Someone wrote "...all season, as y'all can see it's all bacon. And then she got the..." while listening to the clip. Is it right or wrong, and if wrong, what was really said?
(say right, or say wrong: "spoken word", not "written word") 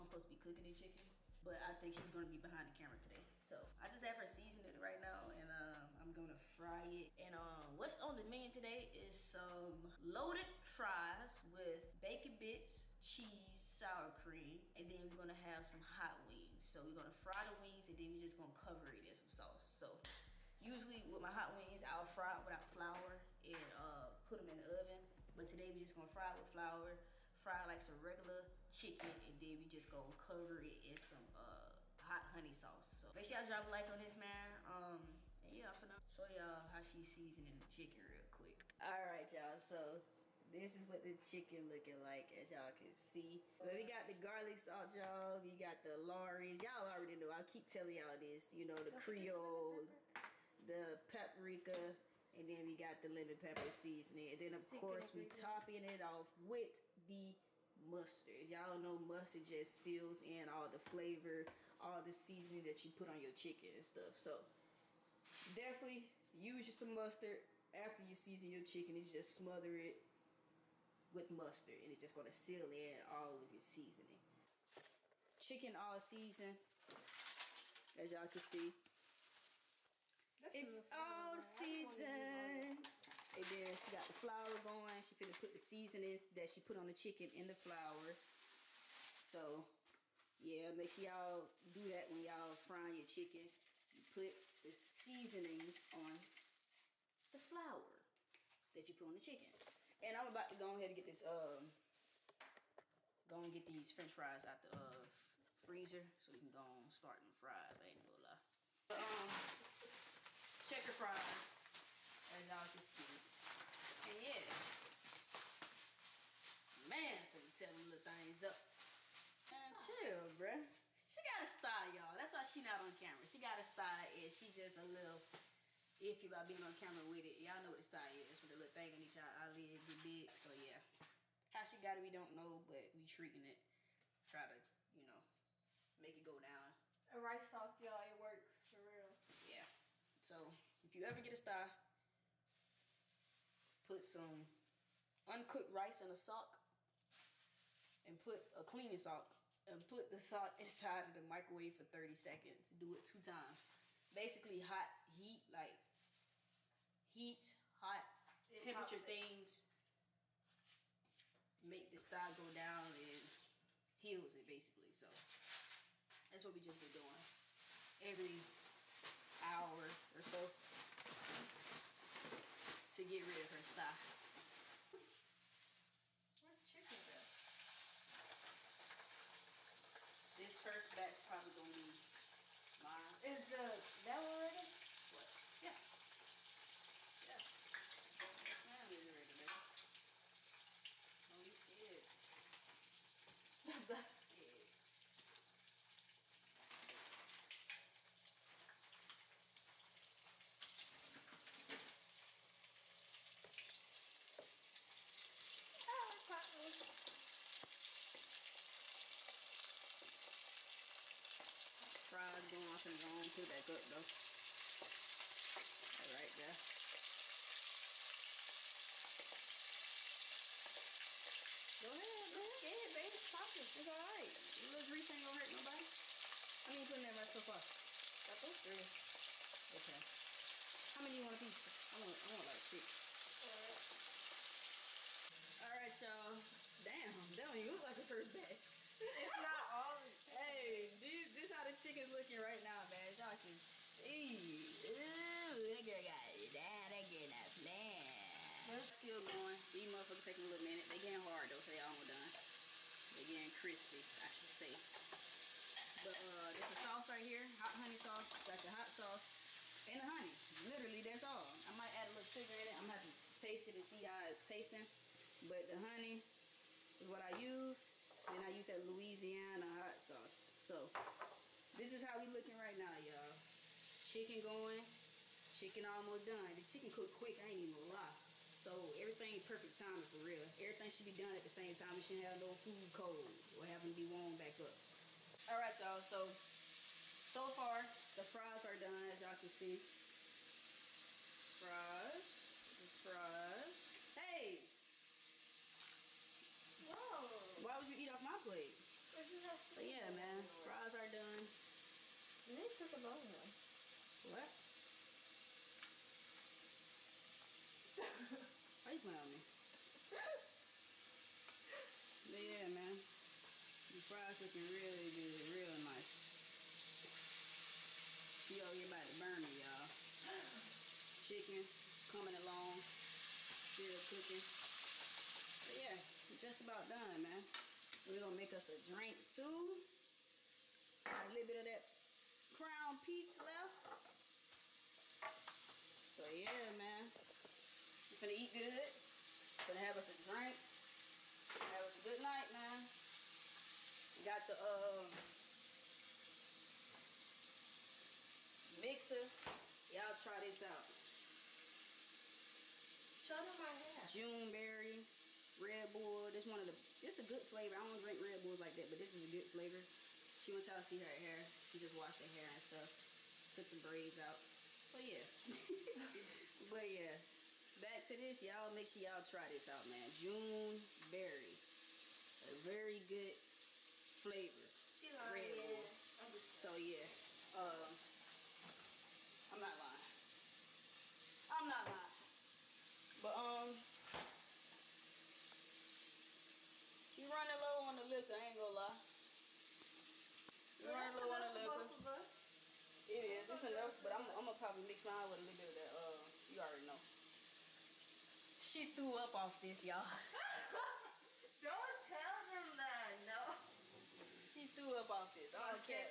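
wrong: "season", not "bacon".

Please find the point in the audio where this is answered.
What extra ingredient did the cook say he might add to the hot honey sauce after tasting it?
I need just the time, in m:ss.
4:22.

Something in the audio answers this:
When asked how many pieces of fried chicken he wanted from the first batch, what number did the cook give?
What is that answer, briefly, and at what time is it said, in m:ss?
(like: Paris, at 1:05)
6, at 3:52.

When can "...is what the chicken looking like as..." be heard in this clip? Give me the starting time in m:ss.
0:40.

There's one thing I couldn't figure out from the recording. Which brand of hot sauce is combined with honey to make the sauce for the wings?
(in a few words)
Louisiana.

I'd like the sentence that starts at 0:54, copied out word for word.
And then, of course, we topping it off with the mustard.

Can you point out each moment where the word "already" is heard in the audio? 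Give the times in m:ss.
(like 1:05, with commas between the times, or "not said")
0:46, 6:36.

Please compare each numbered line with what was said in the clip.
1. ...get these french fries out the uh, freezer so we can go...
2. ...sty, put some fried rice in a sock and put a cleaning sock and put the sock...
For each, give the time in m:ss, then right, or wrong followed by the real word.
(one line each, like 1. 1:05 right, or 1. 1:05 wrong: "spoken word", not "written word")
1. 1:43 right
2. 2:21 wrong: "uncooked", not "fried".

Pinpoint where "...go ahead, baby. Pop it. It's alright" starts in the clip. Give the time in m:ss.
3:42.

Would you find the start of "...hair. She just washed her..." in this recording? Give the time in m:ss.
6:01.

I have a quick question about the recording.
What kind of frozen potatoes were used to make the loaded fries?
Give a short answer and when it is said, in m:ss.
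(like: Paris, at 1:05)
Checker fries, at 1:50.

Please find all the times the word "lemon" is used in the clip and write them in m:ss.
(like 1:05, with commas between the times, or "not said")
0:53.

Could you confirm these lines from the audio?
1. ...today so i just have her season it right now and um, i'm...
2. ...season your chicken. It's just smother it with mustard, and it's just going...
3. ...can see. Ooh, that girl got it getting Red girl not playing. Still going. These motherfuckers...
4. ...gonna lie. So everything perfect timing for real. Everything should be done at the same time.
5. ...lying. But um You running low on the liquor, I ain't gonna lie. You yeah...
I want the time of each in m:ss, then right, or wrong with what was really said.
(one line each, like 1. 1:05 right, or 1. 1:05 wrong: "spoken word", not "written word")
1. 0:02 right
2. 1:08 right
3. 4:03 wrong: "That", not "Red"
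4. 4:37 right
5. 6:21 right.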